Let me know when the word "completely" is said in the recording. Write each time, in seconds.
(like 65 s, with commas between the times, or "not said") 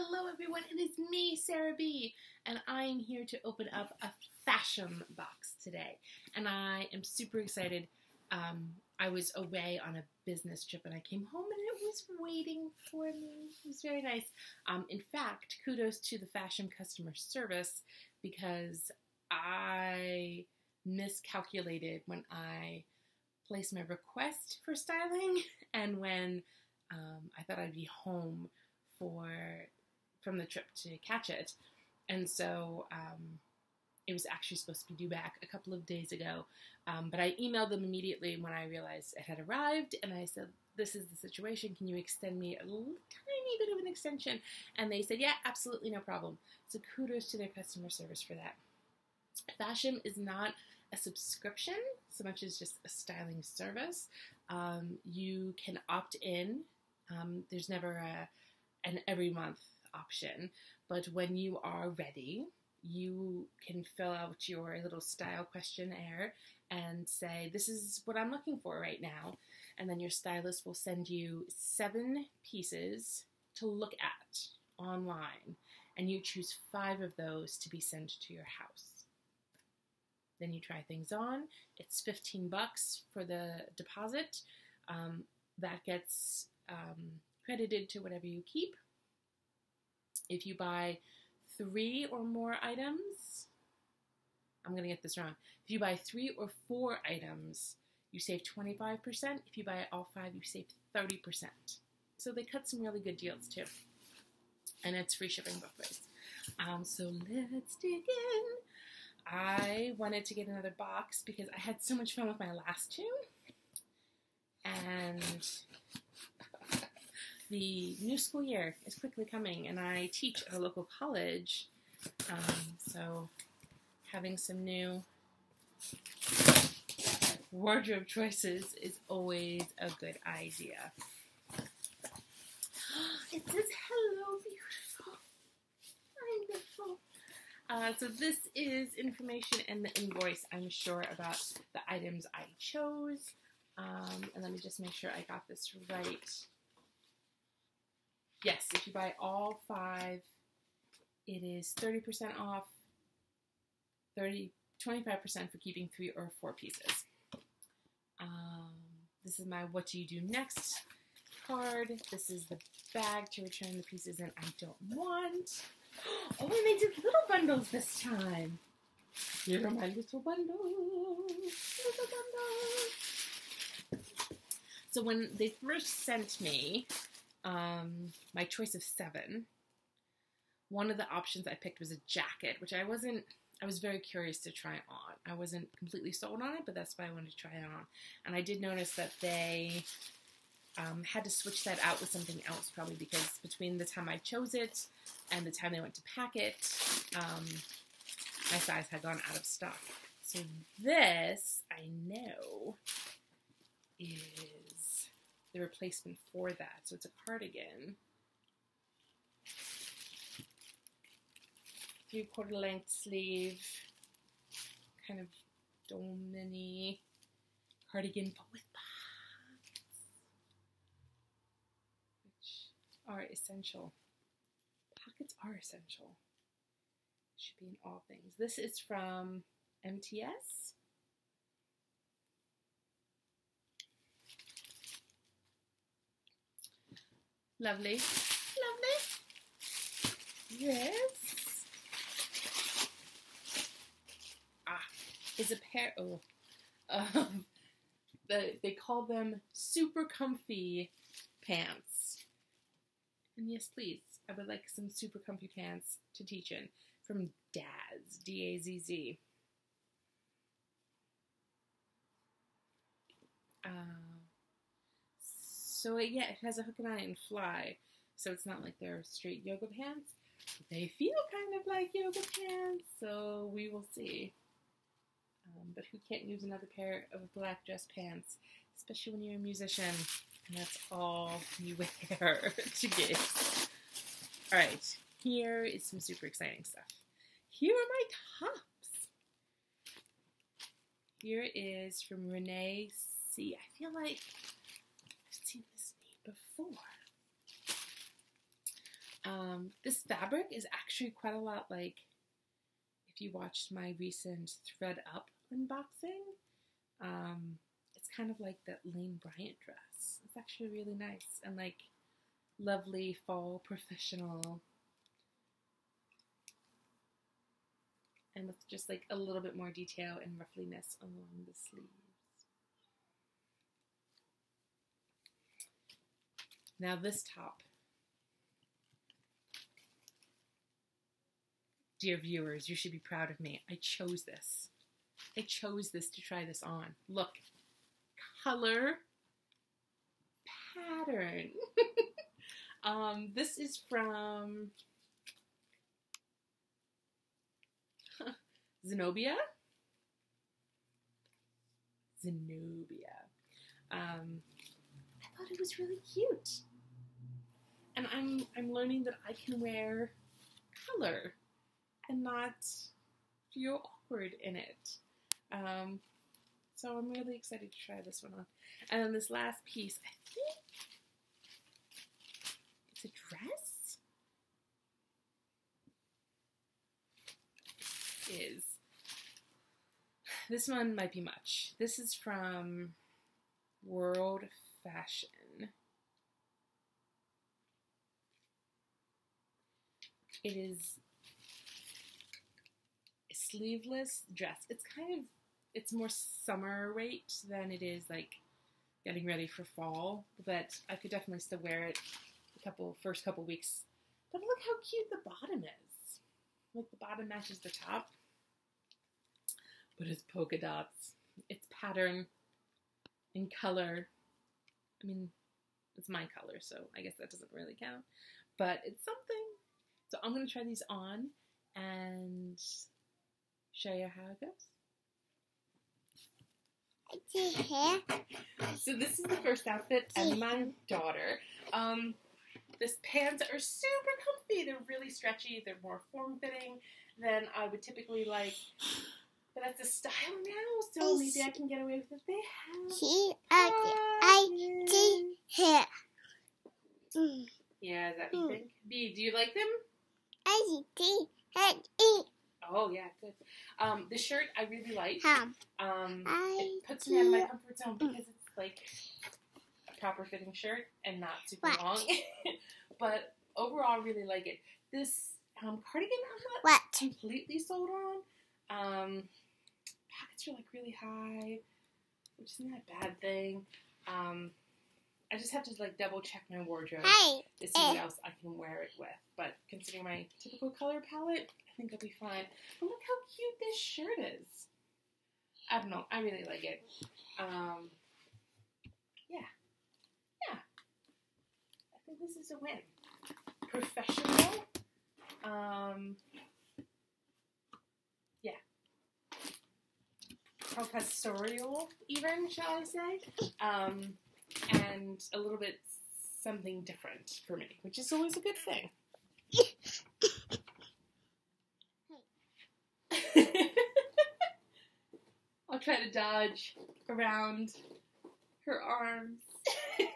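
185 s, 466 s.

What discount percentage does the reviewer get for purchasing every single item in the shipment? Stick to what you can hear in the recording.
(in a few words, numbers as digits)
30%.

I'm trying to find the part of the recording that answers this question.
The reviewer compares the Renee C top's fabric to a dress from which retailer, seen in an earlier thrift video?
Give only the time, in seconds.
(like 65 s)
308 s.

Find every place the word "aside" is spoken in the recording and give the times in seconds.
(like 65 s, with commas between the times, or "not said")
not said.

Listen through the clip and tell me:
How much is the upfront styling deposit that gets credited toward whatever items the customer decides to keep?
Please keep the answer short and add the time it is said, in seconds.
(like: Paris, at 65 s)
$15, at 82 s.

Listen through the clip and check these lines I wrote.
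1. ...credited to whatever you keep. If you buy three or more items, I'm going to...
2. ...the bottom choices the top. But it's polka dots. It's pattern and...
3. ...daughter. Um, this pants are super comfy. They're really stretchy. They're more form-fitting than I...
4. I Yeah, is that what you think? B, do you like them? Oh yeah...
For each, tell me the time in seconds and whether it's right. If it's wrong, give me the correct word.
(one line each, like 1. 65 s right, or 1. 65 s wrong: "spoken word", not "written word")
1. 87 s right
2. 406 s wrong: "matches", not "choices"
3. 430 s right
4. 443 s right.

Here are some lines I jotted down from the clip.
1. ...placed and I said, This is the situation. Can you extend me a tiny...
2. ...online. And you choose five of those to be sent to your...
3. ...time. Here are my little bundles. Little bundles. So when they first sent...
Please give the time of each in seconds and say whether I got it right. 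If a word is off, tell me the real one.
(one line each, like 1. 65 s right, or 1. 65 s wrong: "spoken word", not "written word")
1. 39 s wrong: "arrived", not "placed"
2. 74 s right
3. 168 s right.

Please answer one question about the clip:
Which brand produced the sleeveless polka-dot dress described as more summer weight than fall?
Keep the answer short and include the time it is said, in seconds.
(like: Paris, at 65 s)
World Fashion, at 383 s.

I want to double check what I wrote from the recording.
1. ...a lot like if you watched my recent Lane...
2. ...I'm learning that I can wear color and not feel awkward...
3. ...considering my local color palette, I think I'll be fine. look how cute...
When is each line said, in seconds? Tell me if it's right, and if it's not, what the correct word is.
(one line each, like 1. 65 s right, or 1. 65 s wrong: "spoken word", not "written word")
1. 301 s wrong: "Thread", not "Lane"
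2. 358 s right
3. 479 s wrong: "typical", not "local".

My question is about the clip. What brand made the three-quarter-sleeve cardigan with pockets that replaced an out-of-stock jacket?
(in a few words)
MTS.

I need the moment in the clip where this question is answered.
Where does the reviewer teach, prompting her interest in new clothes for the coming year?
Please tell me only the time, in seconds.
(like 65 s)
120 s.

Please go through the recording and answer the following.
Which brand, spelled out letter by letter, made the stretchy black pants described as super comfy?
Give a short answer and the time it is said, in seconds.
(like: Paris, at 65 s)
Dazz, at 257 s.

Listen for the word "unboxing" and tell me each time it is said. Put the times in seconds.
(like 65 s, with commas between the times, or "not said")
305 s.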